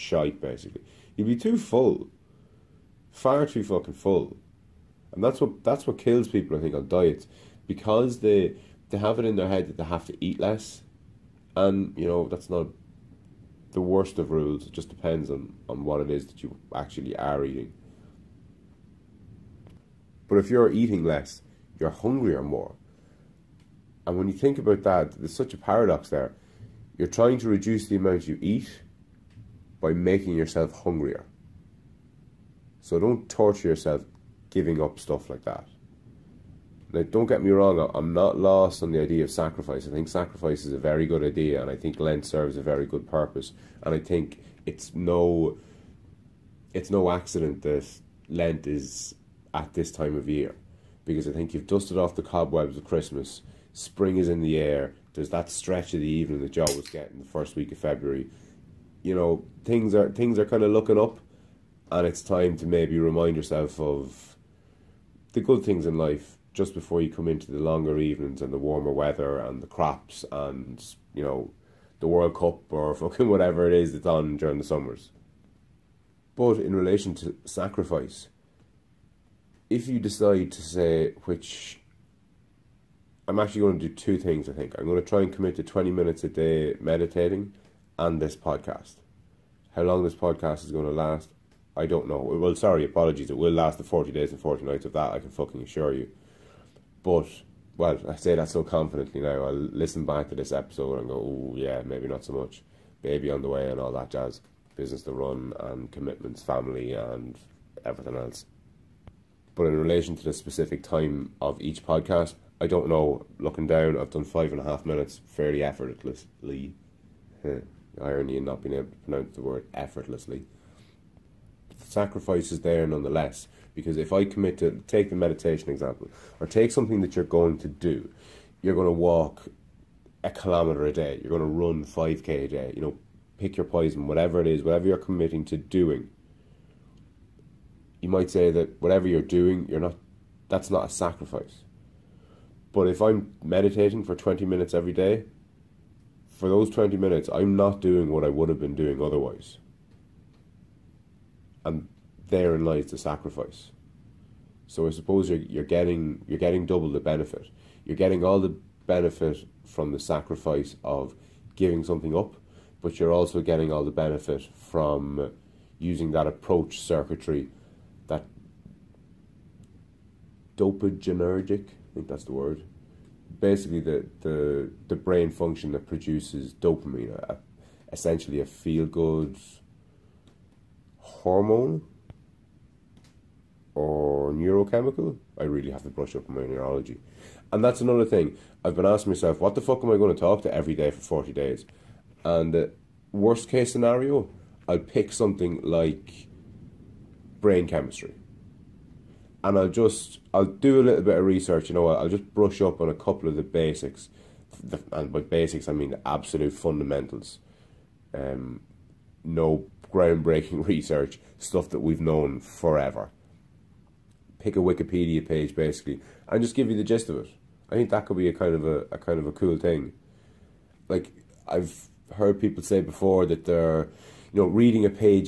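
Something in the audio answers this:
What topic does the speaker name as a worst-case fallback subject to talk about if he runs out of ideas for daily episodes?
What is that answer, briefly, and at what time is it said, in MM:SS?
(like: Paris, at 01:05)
brain chemistry, at 03:17.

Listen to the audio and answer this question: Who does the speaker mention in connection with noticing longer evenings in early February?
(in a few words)
Joe.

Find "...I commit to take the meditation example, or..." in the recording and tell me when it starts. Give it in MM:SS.
02:04.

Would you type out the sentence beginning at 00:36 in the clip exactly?
Now, don't get me wrong, I'm not lost on the idea of sacrifice.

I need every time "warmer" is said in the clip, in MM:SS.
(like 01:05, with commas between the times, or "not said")
01:08.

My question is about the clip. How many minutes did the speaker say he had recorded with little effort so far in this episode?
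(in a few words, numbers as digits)
5.5 minutes.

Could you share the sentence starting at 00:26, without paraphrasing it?
You're trying to reduce the amount you eat by making yourself hungrier.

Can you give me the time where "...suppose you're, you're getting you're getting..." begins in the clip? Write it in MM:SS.
02:34.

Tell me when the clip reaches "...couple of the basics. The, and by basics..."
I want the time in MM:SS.
03:22.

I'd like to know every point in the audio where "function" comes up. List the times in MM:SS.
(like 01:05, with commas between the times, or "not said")
02:55.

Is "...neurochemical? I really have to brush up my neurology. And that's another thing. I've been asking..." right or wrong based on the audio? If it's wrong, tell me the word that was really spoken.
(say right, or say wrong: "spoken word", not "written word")
right.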